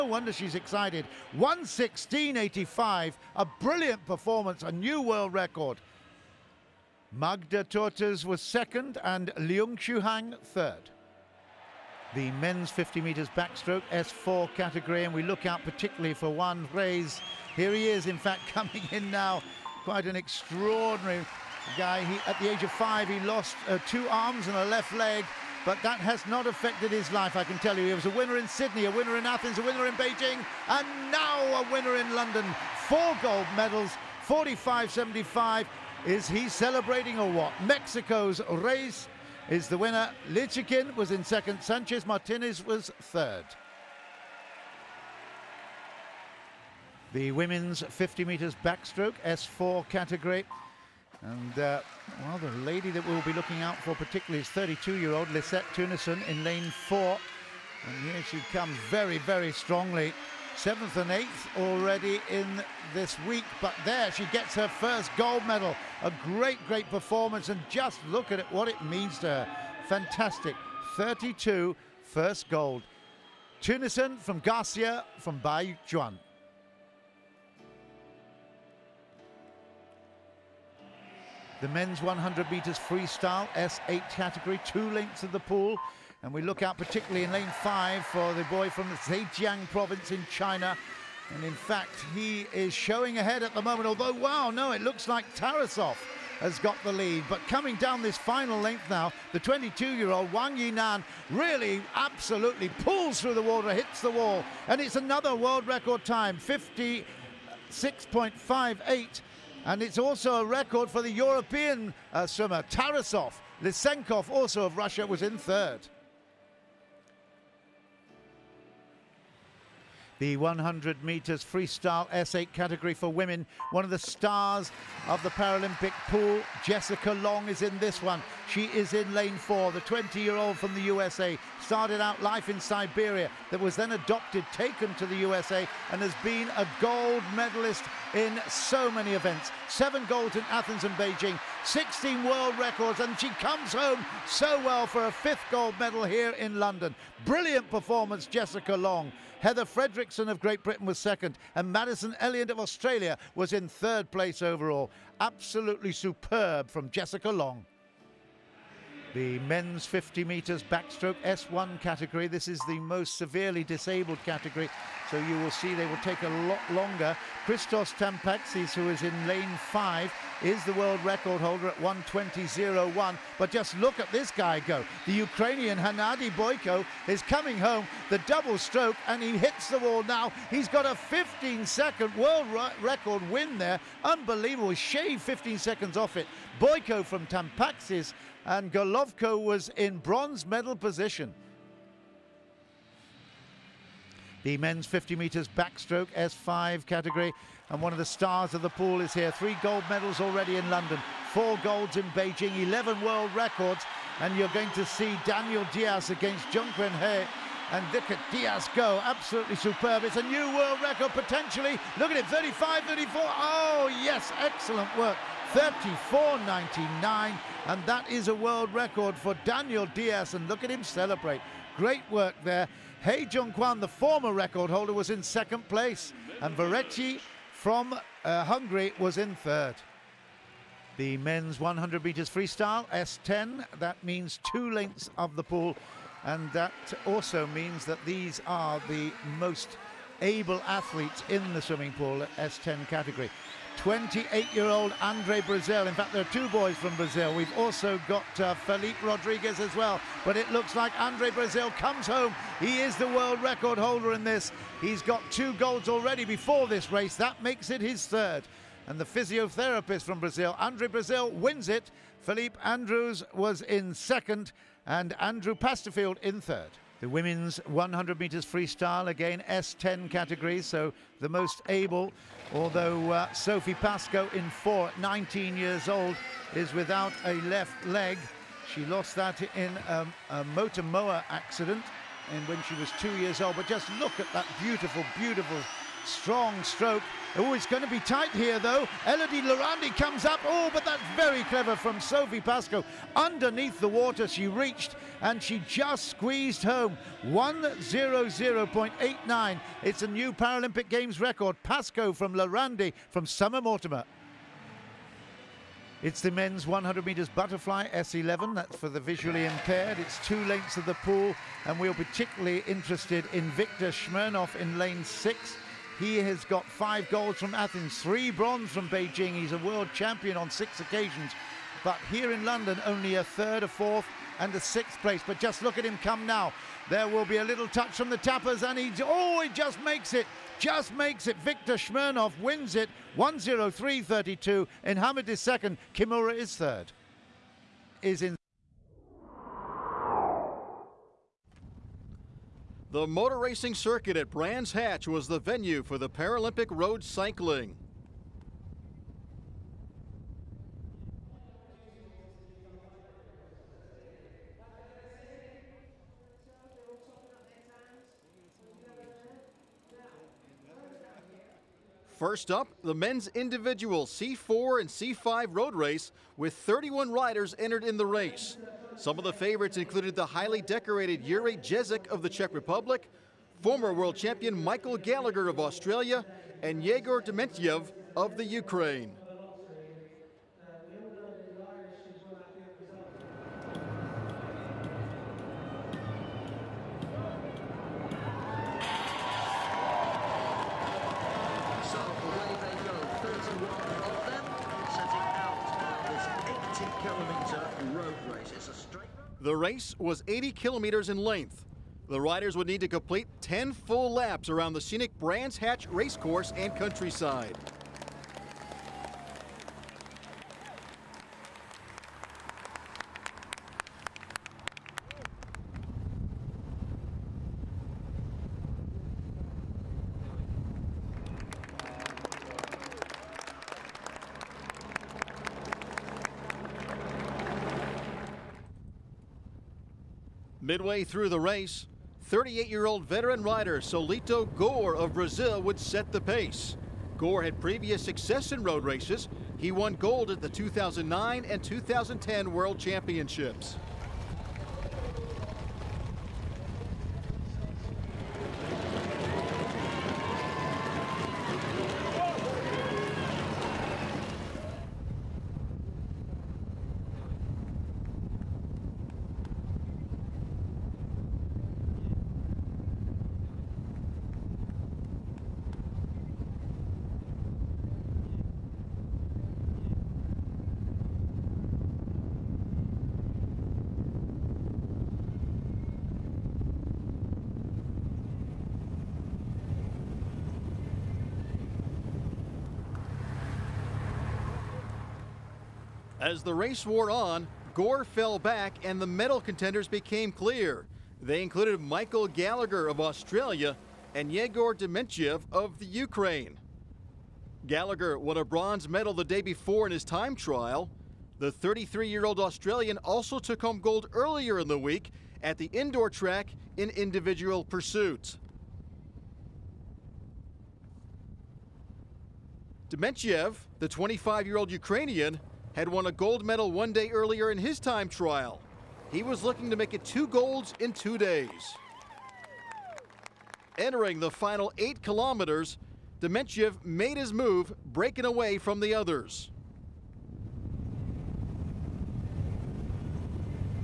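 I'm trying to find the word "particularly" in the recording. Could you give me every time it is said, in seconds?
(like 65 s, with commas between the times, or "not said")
15 s, 53 s, 86 s, 311 s.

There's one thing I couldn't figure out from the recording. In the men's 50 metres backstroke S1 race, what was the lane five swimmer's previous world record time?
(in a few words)
120.01.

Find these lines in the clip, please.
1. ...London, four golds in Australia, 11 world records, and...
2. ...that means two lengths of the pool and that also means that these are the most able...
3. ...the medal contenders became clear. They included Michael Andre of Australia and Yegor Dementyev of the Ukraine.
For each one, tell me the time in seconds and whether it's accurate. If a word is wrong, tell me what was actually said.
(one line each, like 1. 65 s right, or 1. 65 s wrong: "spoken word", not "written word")
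1. 200 s wrong: "Beijing", not "Australia"
2. 233 s right
3. 488 s wrong: "Gallagher", not "Andre".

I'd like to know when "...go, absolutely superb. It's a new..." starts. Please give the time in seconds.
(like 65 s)
208 s.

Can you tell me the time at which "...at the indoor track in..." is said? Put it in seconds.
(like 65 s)
505 s.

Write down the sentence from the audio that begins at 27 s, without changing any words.
He was a winner in Sydney, a winner in Athens, a winner in Beijing, and now a winner in London.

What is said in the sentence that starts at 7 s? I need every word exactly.
Magda Toeters was second and Leung Hang third.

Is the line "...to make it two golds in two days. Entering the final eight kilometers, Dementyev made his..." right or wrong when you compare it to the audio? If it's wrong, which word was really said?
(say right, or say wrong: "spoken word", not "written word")
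right.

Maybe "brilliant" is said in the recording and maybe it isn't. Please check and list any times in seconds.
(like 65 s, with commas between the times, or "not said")
3 s, 147 s.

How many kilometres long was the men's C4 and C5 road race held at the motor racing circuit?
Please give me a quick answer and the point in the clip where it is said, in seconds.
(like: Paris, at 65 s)
80, at 400 s.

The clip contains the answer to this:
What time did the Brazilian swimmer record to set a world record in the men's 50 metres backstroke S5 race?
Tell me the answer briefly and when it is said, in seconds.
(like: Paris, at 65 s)
34.99, at 215 s.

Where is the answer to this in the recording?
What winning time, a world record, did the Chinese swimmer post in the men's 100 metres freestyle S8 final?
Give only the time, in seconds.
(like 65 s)
106 s.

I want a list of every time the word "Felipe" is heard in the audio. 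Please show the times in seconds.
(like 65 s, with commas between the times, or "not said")
248 s, 262 s.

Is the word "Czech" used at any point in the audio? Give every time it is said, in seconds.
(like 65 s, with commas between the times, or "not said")
372 s.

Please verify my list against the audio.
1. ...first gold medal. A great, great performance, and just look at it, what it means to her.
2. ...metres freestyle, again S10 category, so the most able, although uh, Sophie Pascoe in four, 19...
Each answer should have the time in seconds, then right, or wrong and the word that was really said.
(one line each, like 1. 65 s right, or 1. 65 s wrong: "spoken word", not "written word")
1. 64 s right
2. 268 s right.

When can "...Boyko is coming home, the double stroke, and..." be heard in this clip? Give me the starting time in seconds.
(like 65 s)
176 s.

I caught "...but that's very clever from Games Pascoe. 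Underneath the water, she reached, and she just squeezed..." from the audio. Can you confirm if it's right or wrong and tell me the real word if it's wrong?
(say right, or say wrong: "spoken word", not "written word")
wrong: "Sophie", not "Games".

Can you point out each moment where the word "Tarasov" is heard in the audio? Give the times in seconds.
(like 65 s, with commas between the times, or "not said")
95 s, 112 s.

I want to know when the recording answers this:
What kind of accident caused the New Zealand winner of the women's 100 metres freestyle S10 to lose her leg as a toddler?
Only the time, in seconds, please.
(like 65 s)
280 s.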